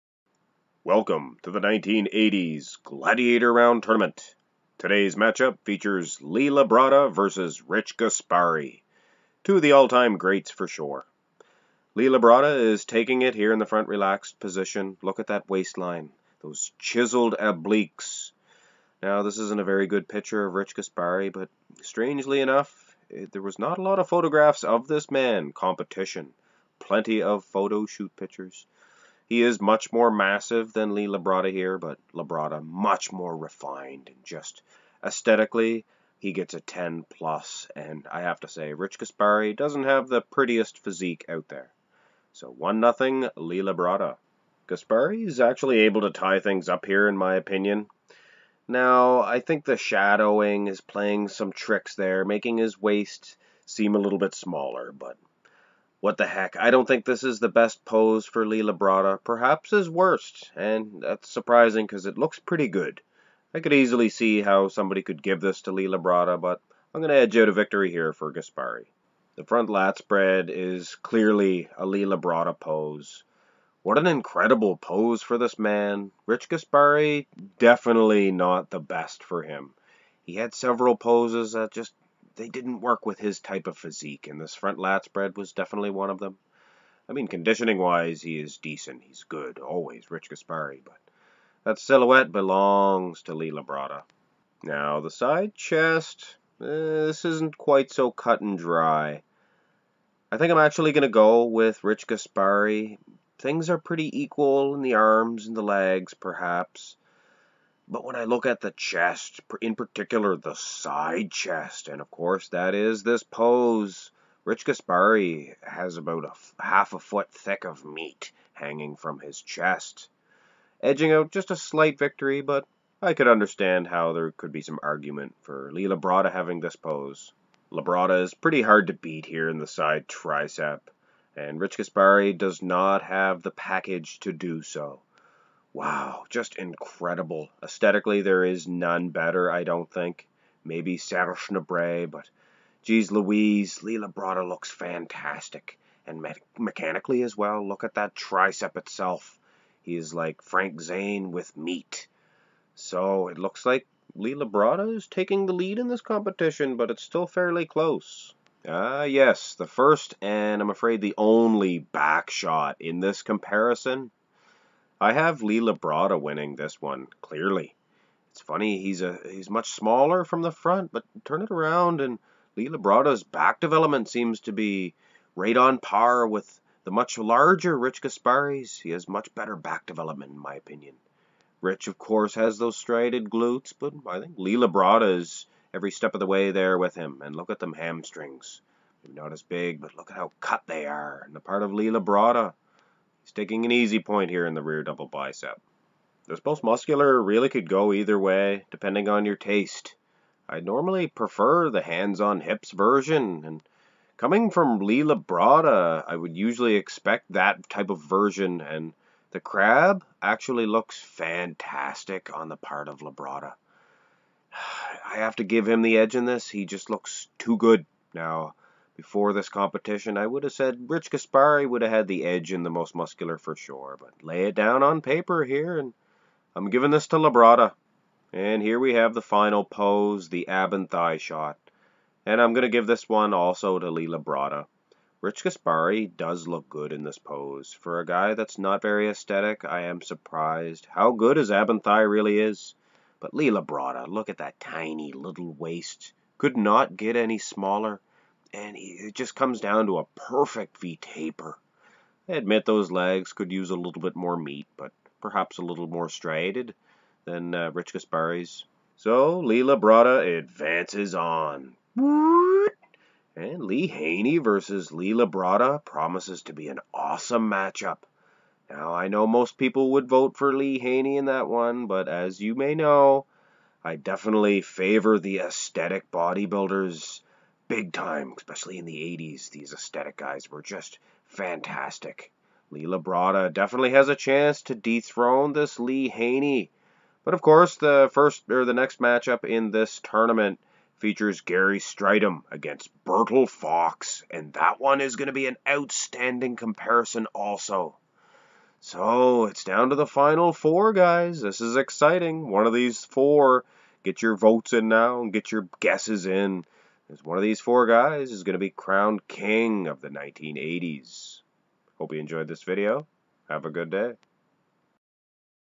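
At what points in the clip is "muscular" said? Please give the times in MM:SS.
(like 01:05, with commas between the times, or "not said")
03:16, 03:42.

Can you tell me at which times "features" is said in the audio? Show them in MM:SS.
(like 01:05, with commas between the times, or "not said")
00:05, 04:50.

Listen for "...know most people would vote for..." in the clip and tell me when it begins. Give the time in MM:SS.
04:29.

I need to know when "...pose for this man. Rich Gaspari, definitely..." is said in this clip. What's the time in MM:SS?
01:14.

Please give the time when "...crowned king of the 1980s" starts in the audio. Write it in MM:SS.
05:08.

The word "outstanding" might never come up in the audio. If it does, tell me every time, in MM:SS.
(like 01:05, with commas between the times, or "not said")
04:55.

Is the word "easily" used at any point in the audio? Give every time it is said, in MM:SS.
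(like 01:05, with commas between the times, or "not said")
01:03.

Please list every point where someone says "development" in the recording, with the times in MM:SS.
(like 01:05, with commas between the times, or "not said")
02:53, 02:59.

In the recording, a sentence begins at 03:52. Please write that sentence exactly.
And I'm going to give this one also to Lee Labrada.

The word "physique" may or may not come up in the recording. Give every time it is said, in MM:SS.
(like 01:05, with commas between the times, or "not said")
00:40, 01:23.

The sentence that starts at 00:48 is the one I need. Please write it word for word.
Now, I think the shadowing is playing some tricks there, making his waist seem a little bit smaller, but what the heck?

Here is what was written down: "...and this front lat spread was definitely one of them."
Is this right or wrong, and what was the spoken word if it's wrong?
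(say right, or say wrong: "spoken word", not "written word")
right.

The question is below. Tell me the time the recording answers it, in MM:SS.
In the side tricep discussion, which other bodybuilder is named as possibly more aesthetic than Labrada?
02:20.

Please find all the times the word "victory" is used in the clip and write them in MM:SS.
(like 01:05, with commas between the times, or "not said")
01:07, 02:01.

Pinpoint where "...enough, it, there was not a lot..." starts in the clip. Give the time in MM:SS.
00:22.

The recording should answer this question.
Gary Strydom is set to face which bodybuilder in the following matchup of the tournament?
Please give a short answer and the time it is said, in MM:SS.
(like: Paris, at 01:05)
Bertil Fox, at 04:53.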